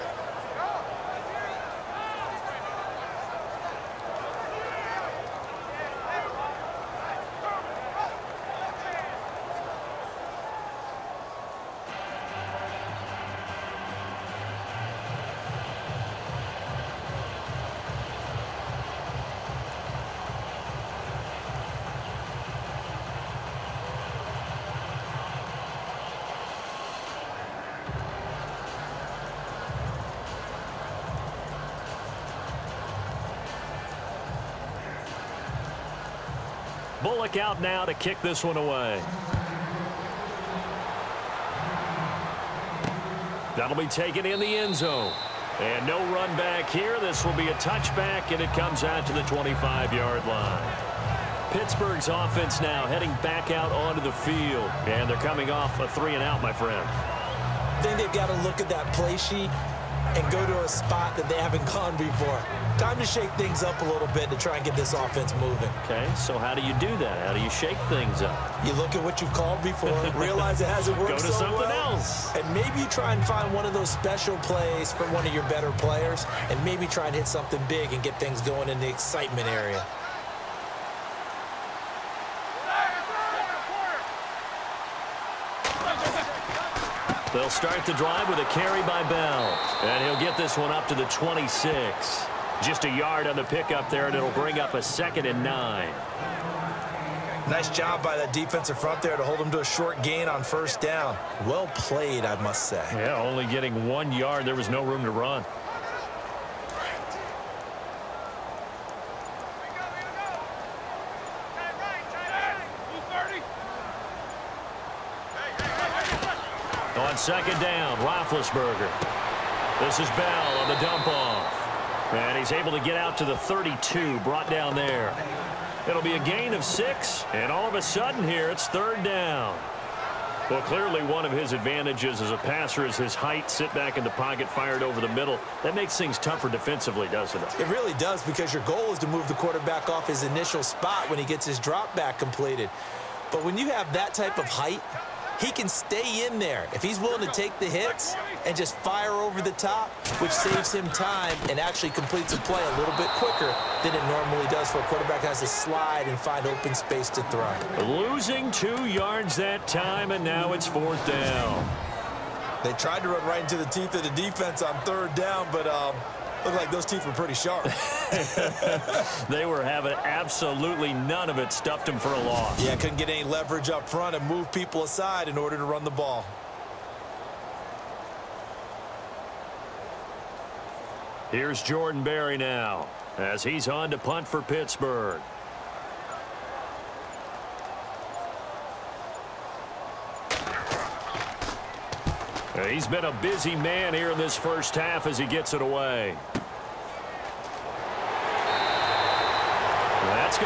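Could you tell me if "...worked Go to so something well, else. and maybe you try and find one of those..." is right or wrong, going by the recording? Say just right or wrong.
right.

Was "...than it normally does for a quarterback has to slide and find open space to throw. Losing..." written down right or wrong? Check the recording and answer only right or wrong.
right.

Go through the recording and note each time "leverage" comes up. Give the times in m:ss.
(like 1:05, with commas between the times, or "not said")
2:53.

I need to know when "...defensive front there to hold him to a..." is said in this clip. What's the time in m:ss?
1:38.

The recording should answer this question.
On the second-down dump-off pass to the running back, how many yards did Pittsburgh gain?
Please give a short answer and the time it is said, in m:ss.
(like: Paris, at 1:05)
6, at 2:06.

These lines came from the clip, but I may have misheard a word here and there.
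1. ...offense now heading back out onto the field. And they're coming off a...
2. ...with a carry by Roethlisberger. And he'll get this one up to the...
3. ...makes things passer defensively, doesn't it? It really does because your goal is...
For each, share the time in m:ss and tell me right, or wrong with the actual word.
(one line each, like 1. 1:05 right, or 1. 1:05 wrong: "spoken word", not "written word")
1. 0:52 right
2. 1:28 wrong: "Bell", not "Roethlisberger"
3. 2:15 wrong: "tougher", not "passer".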